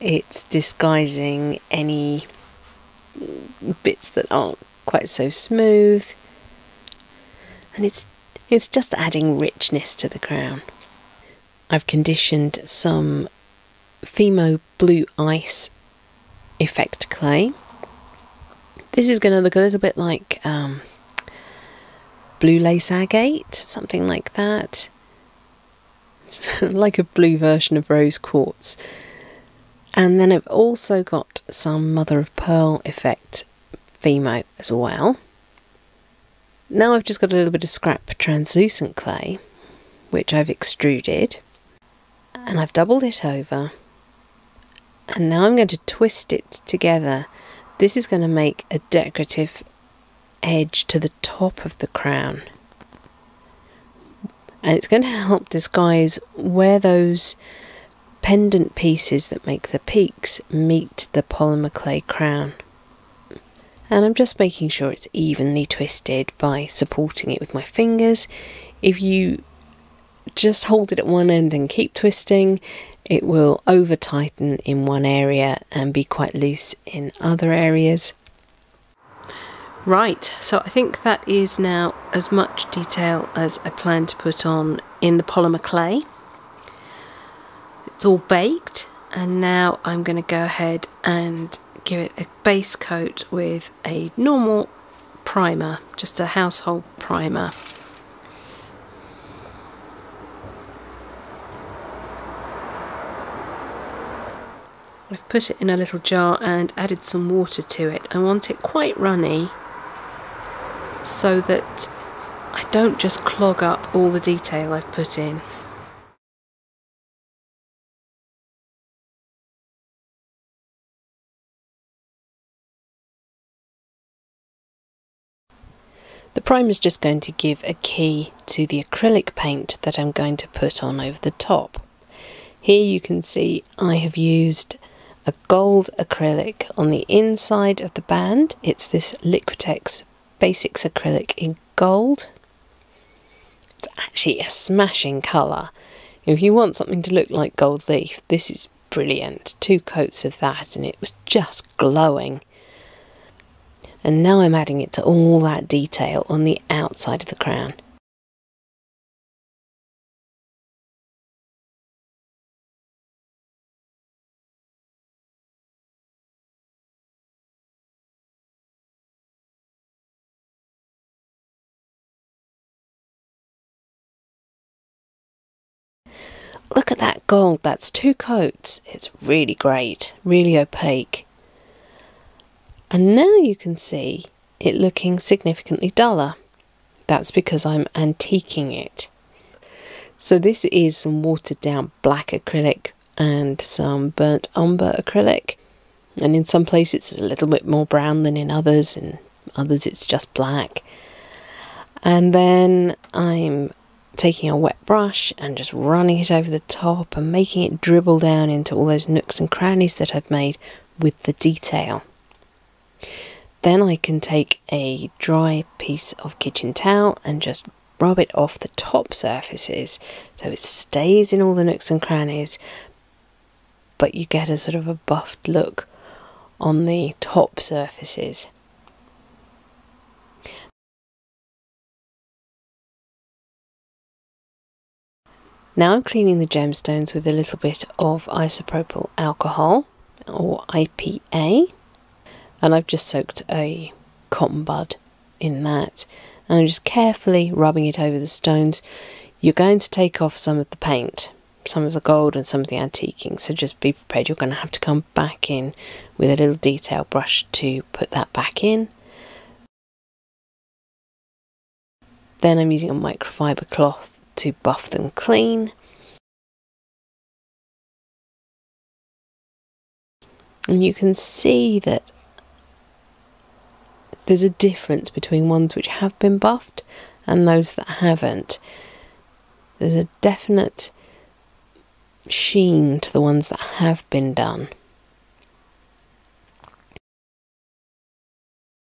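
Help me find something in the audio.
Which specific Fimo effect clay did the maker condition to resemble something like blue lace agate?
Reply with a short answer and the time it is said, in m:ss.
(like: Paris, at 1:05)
Blue Ice, at 0:14.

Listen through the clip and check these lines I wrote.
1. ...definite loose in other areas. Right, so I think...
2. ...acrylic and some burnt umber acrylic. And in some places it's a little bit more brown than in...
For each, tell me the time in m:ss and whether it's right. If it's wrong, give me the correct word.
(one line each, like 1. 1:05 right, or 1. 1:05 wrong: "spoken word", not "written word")
1. 1:16 wrong: "quite", not "definite"
2. 3:12 right.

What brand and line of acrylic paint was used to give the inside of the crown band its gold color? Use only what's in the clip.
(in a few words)
Liquitex Basics.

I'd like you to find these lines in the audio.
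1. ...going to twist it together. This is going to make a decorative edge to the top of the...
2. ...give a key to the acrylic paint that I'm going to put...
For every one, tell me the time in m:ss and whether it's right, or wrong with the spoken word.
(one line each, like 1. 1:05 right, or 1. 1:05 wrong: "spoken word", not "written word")
1. 0:45 right
2. 2:07 right.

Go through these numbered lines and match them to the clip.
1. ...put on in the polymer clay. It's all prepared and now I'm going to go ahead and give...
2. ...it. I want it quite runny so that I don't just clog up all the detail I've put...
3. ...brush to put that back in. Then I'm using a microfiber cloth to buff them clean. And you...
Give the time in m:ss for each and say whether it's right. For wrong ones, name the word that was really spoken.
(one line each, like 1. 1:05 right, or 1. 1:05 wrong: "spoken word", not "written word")
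1. 1:24 wrong: "baked", not "prepared"
2. 1:47 right
3. 4:17 right.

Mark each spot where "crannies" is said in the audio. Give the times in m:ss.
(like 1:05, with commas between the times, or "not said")
3:29, 3:42.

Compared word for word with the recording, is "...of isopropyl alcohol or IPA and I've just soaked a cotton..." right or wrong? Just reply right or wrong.
right.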